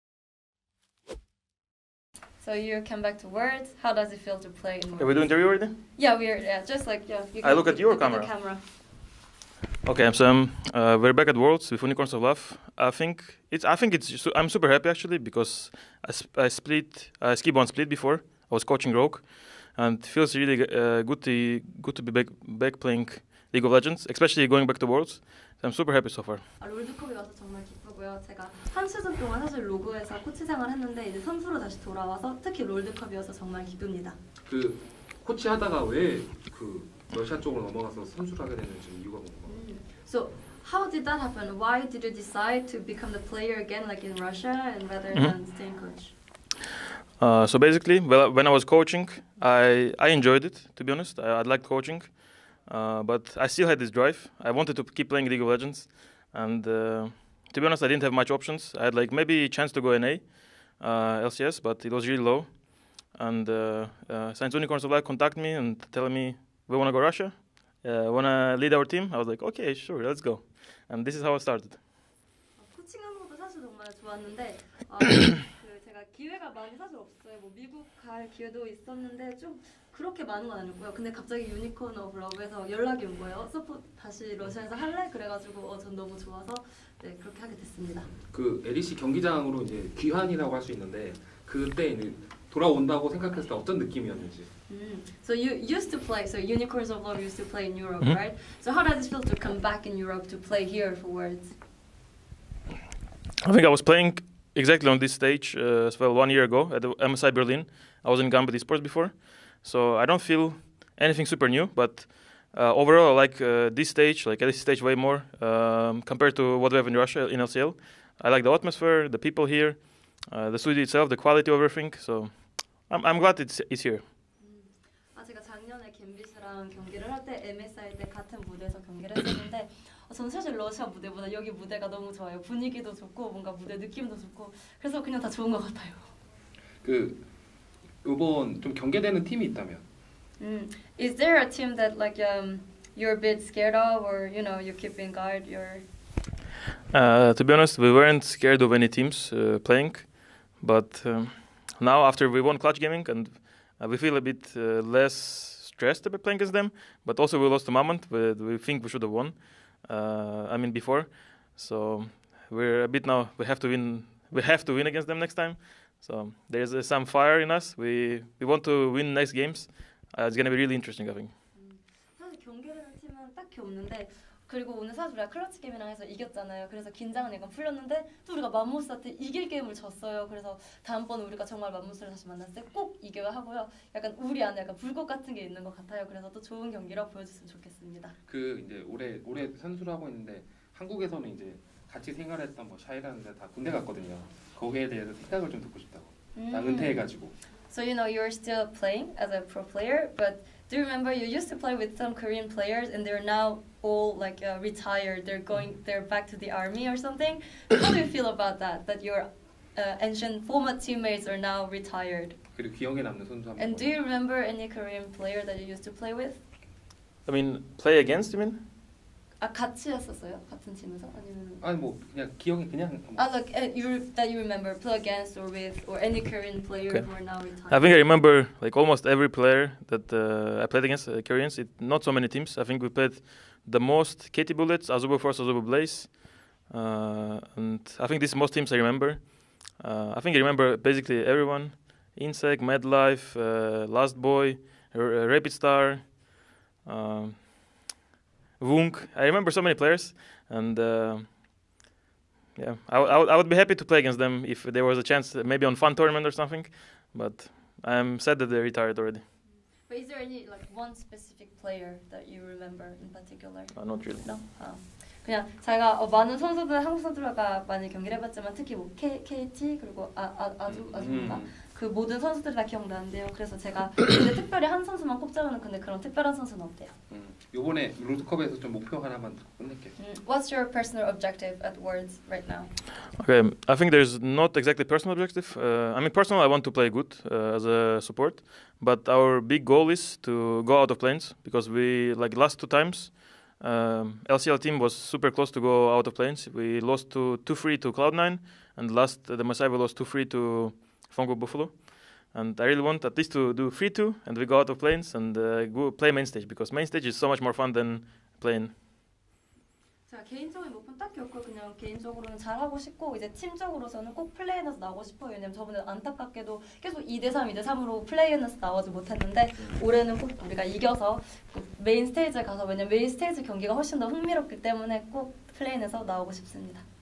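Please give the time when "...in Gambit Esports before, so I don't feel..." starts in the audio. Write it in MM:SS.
01:48.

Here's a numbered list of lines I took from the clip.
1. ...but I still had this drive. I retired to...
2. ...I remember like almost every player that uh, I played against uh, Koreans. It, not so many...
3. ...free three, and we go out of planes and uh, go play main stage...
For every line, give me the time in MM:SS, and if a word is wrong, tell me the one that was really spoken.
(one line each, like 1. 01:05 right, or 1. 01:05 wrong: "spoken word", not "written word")
1. 00:53 wrong: "wanted", not "retired"
2. 03:47 right
3. 05:03 wrong: "two", not "three".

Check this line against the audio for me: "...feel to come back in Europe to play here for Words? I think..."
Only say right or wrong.
right.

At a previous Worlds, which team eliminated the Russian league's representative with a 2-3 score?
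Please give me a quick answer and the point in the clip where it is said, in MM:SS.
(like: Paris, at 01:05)
Cloud9, at 04:56.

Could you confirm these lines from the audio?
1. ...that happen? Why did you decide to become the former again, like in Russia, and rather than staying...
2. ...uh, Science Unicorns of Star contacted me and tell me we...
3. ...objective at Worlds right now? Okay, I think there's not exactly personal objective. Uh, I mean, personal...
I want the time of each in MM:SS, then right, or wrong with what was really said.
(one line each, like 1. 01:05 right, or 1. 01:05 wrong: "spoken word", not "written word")
1. 00:41 wrong: "player", not "former"
2. 01:04 wrong: "Light", not "Star"
3. 04:41 right.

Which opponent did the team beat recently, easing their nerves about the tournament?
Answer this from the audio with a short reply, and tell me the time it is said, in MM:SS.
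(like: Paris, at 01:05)
Clutch Gaming, at 02:32.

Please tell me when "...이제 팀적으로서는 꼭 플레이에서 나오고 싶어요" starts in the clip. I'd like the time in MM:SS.
05:13.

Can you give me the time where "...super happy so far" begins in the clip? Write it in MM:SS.
00:25.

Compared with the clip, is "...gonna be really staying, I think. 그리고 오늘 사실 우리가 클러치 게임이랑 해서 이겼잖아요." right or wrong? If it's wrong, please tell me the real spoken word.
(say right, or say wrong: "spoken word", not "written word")
wrong: "interesting", not "staying".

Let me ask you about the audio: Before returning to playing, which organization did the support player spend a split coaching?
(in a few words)
Rogue.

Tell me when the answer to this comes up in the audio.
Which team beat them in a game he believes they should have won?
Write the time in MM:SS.
02:37.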